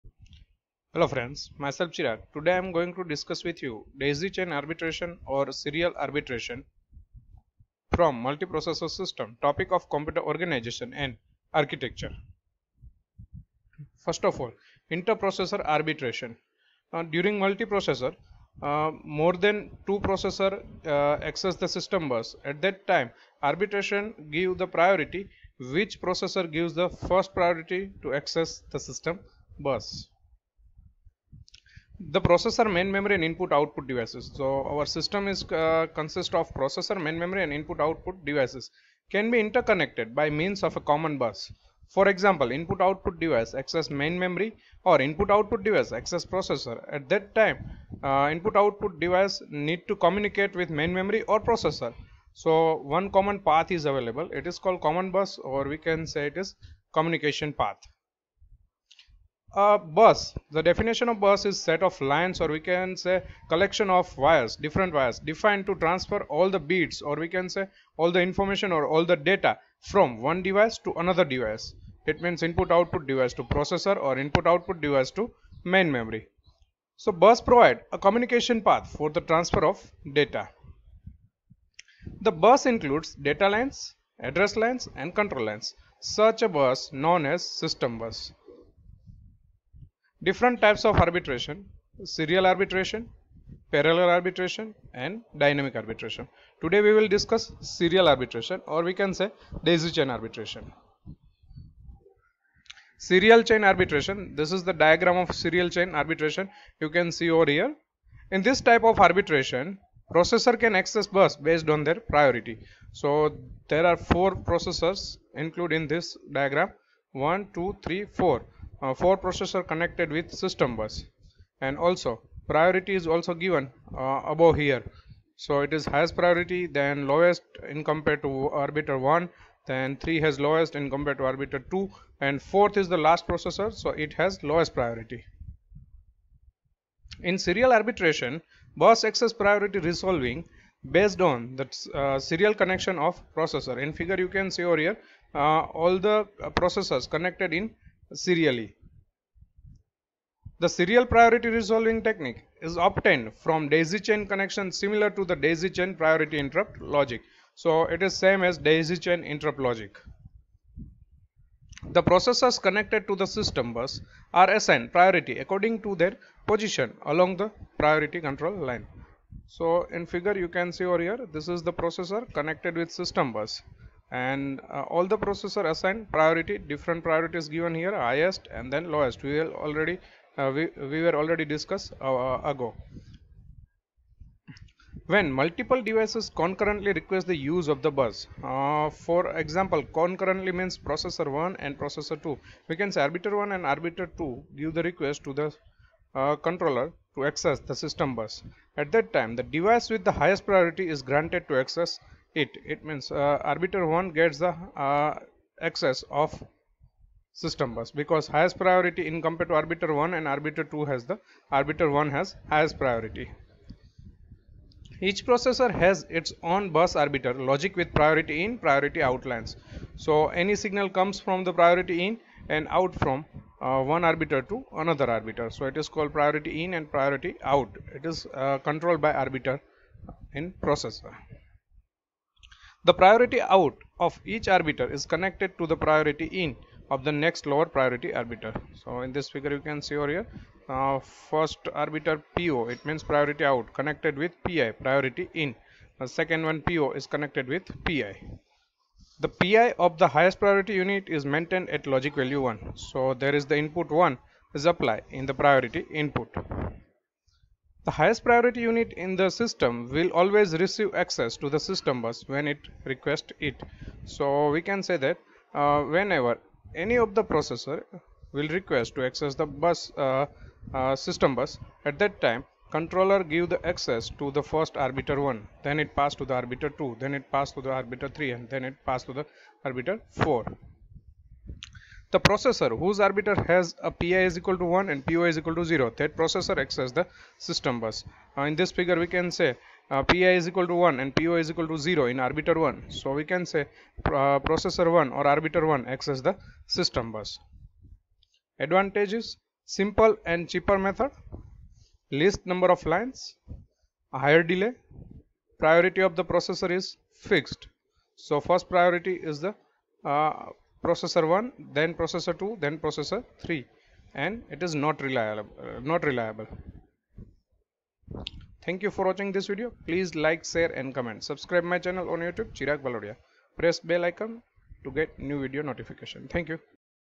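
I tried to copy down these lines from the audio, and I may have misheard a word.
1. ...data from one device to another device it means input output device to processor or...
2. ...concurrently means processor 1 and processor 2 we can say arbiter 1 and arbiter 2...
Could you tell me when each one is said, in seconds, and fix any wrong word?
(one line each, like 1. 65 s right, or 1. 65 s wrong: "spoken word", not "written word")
1. 69 s right
2. 189 s right.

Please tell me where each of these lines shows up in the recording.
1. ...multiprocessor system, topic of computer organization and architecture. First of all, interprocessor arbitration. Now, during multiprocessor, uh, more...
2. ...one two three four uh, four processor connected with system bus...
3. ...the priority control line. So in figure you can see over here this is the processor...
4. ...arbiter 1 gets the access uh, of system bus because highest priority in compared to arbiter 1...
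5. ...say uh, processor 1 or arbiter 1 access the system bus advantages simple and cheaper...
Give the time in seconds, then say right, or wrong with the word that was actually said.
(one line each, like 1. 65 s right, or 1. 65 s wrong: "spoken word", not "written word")
1. 8 s right
2. 117 s right
3. 167 s right
4. 203 s right
5. 293 s right.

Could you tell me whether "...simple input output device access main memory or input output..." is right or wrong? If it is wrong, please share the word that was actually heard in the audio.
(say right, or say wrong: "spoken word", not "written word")
wrong: "example", not "simple".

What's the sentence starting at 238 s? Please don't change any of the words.
So in this figure you can see over here uh, first arbiter PO it means priority out connected with PI priority in.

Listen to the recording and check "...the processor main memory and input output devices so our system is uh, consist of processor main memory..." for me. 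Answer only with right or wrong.
right.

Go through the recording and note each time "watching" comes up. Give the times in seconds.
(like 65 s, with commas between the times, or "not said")
319 s.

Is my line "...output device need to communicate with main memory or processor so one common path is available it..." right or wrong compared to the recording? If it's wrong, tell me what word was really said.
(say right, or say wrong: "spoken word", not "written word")
right.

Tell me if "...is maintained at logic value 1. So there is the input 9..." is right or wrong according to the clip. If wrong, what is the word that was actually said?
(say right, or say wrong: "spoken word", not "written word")
wrong: "1", not "9".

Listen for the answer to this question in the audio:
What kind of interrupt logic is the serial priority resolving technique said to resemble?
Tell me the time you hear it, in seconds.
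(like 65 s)
155 s.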